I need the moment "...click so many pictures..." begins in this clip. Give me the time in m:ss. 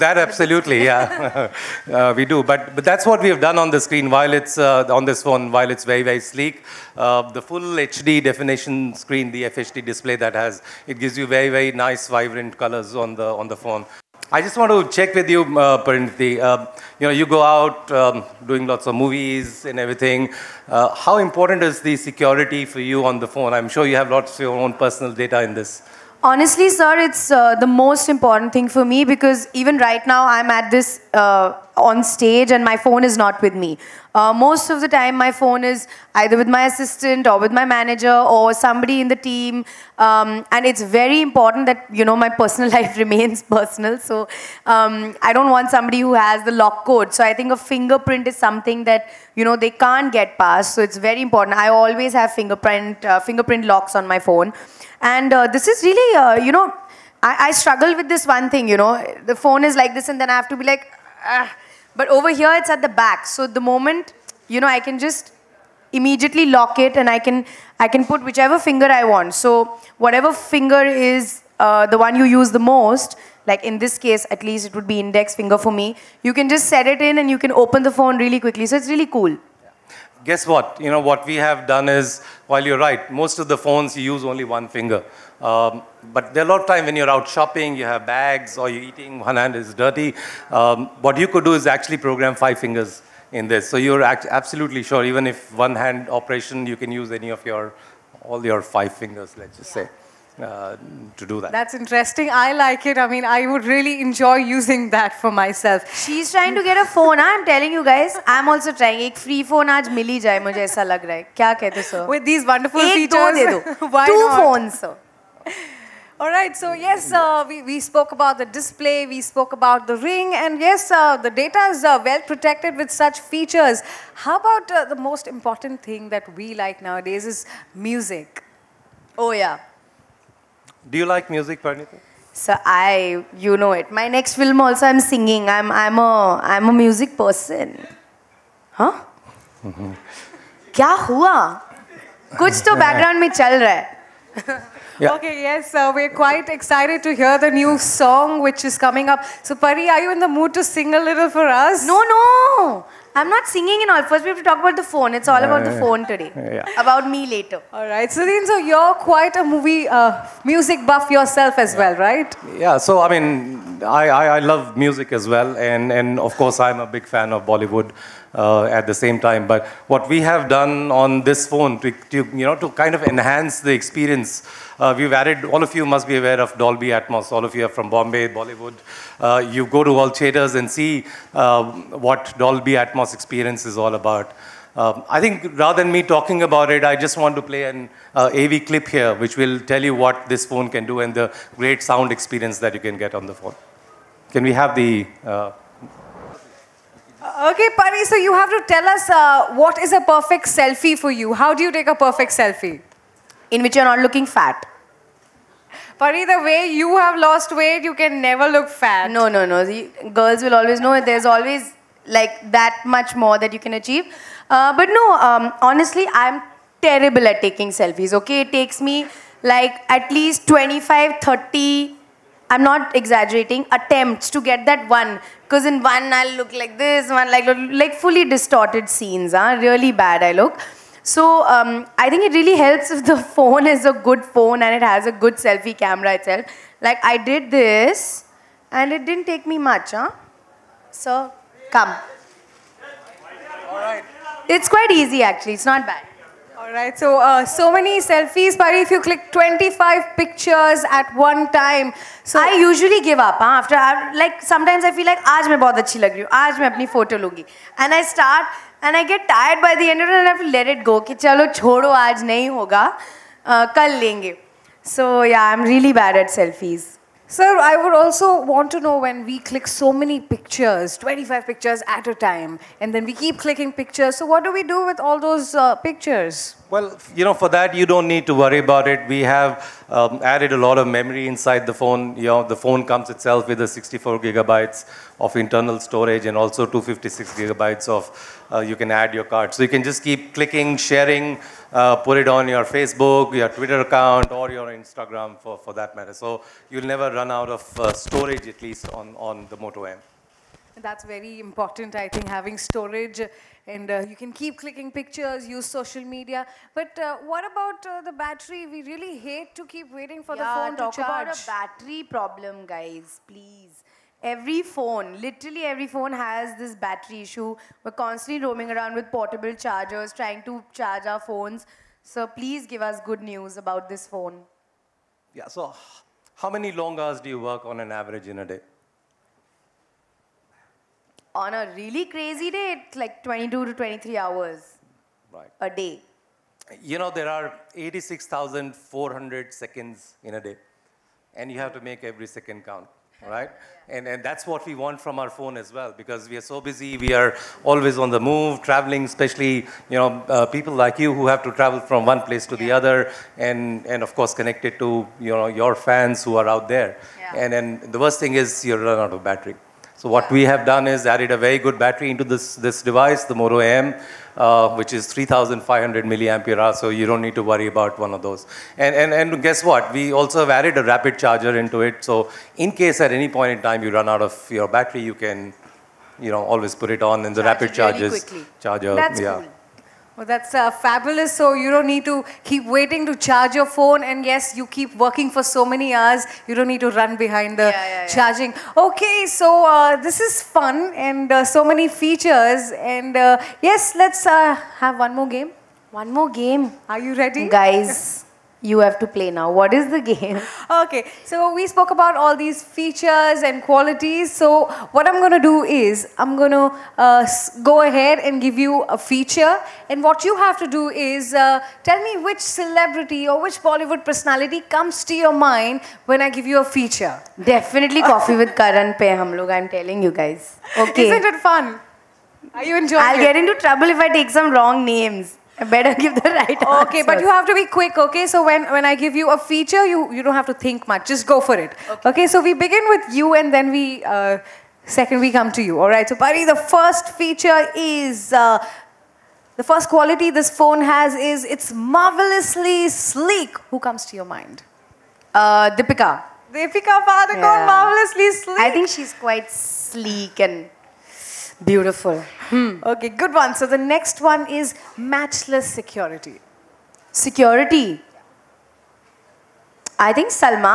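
4:29.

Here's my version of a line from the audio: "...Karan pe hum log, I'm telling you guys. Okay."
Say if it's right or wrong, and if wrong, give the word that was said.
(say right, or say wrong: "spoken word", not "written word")
right.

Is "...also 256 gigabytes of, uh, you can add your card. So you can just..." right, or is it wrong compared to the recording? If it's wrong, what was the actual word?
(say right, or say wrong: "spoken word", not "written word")
right.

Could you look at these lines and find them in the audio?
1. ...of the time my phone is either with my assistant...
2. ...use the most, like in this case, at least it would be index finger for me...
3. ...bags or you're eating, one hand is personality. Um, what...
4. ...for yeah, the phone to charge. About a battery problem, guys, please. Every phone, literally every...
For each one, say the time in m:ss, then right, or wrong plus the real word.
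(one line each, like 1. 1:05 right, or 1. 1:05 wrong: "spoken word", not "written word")
1. 0:34 right
2. 1:12 right
3. 1:28 wrong: "dirty", not "personality"
4. 5:10 right.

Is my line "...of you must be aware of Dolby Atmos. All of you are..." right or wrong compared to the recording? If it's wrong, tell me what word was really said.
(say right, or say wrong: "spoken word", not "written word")
right.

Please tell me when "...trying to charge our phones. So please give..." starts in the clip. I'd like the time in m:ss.
5:20.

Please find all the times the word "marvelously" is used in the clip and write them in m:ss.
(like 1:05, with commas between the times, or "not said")
7:21, 7:27.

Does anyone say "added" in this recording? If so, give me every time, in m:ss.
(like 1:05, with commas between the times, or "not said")
2:55, 4:40, 6:01, 6:10.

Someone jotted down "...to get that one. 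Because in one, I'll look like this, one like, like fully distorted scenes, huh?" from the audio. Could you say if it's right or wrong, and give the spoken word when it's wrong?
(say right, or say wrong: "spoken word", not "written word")
right.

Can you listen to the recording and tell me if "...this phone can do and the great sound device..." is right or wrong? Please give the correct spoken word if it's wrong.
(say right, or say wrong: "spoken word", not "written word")
wrong: "experience", not "device".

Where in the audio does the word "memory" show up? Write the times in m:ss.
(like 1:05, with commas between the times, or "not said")
4:40.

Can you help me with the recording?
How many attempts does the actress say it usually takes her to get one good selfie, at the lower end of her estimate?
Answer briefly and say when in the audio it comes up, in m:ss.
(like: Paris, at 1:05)
25, at 3:40.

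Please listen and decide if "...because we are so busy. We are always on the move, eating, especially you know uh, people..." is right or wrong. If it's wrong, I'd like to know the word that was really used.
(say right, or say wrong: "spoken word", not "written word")
wrong: "traveling", not "eating".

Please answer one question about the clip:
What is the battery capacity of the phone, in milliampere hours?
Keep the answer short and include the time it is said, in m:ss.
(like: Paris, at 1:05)
3,500 mAh, at 6:05.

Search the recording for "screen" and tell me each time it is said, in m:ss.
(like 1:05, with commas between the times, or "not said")
0:03, 0:08.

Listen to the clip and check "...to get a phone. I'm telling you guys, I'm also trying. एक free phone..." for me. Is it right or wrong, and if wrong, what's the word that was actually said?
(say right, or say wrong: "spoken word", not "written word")
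right.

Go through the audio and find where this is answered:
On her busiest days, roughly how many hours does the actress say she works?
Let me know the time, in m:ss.
5:33.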